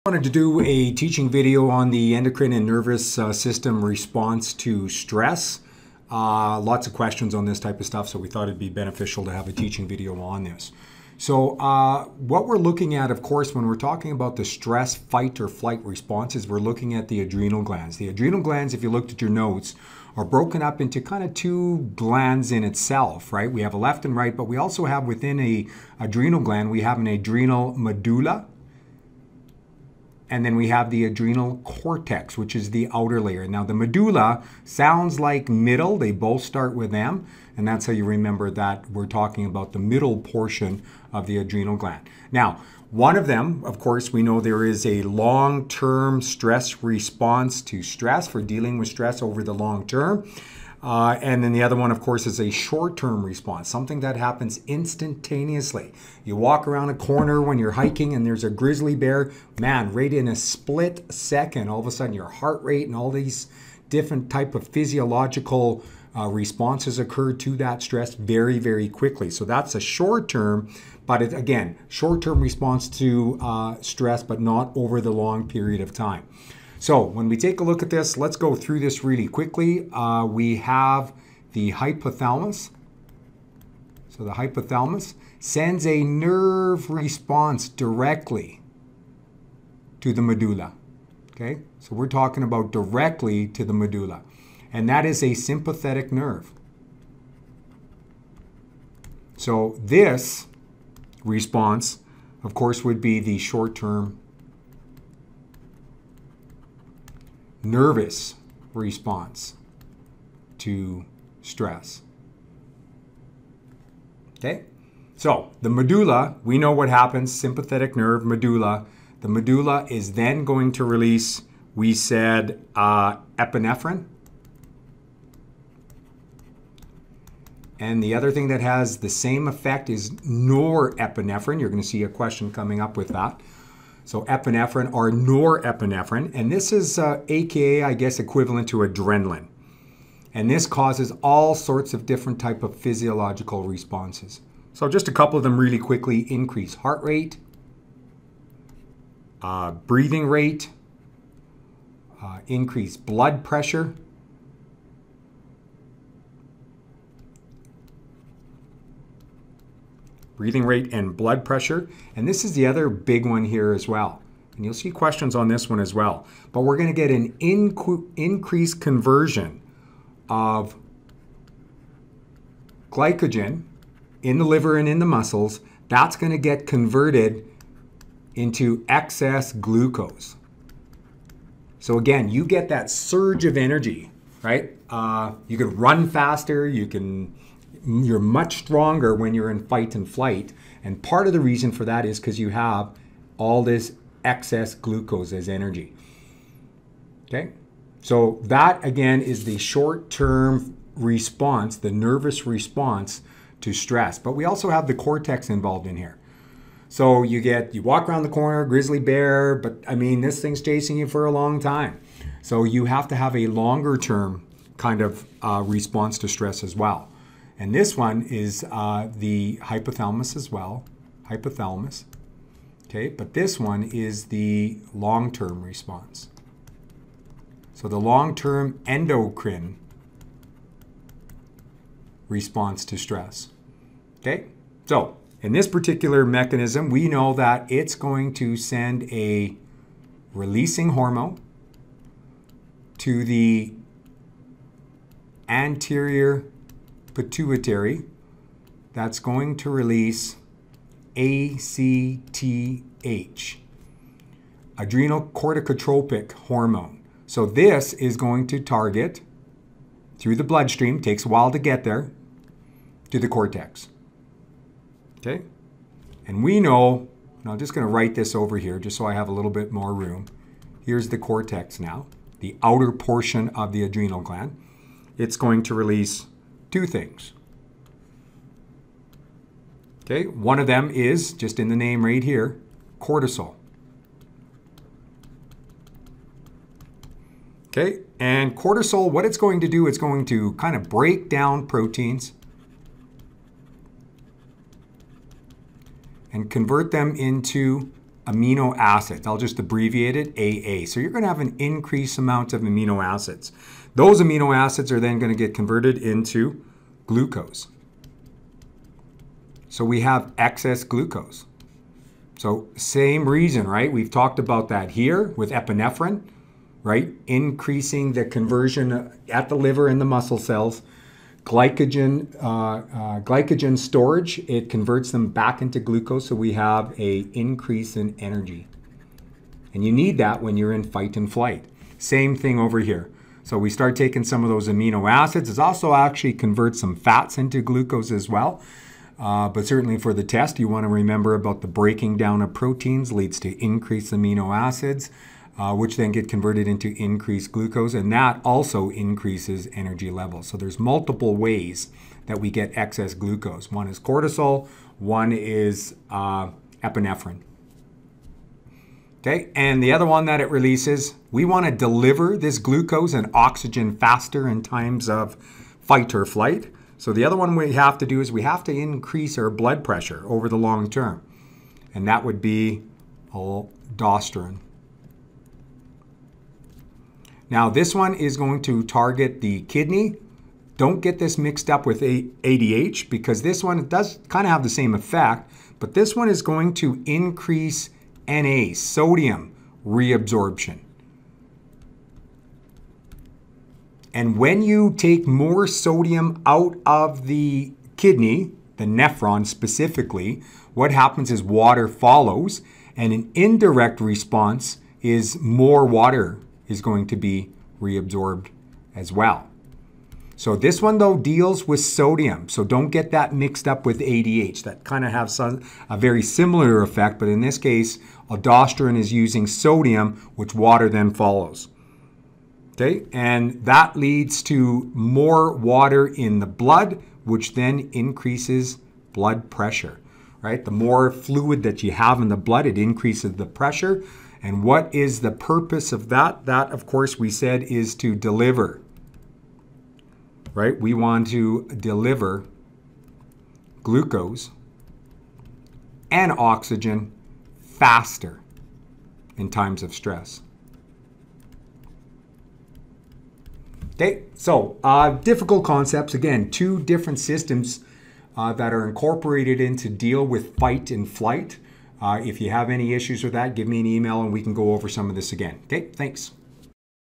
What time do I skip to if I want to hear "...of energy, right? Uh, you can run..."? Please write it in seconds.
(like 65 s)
183 s.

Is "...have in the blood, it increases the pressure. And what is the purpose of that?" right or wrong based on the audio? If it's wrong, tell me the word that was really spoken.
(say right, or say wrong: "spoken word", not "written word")
right.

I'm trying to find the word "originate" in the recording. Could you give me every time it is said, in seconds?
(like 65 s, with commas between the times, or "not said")
not said.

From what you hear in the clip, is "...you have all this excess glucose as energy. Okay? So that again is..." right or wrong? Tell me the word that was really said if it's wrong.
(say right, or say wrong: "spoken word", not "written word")
right.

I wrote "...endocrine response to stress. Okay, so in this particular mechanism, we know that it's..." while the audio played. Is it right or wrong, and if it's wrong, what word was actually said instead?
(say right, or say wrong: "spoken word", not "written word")
right.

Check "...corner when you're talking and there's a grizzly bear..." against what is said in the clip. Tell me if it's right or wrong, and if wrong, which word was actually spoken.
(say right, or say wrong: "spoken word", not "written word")
wrong: "hiking", not "talking".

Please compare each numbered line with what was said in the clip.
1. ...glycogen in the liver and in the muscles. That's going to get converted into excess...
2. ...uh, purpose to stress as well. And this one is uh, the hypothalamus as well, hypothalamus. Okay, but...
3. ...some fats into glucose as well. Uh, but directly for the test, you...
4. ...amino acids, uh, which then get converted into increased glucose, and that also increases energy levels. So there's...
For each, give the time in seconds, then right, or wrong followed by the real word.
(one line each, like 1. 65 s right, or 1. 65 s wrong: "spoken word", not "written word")
1. 172 s right
2. 215 s wrong: "response", not "purpose"
3. 336 s wrong: "certainly", not "directly"
4. 344 s right.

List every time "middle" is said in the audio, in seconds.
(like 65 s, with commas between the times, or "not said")
35 s, 39 s.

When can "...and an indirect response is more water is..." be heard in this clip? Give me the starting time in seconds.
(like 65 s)
402 s.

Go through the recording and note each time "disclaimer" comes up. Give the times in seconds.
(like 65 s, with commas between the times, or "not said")
not said.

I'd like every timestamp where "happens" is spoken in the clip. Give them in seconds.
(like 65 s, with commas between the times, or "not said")
54 s, 116 s, 400 s.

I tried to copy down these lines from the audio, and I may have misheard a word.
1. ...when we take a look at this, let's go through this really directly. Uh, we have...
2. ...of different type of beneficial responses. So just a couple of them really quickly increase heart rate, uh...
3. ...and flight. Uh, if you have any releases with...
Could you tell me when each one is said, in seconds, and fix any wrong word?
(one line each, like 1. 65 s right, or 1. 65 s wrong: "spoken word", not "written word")
1. 77 s wrong: "quickly", not "directly"
2. 141 s wrong: "physiological", not "beneficial"
3. 460 s wrong: "issues", not "releases".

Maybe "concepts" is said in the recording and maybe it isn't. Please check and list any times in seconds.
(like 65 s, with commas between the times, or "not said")
455 s.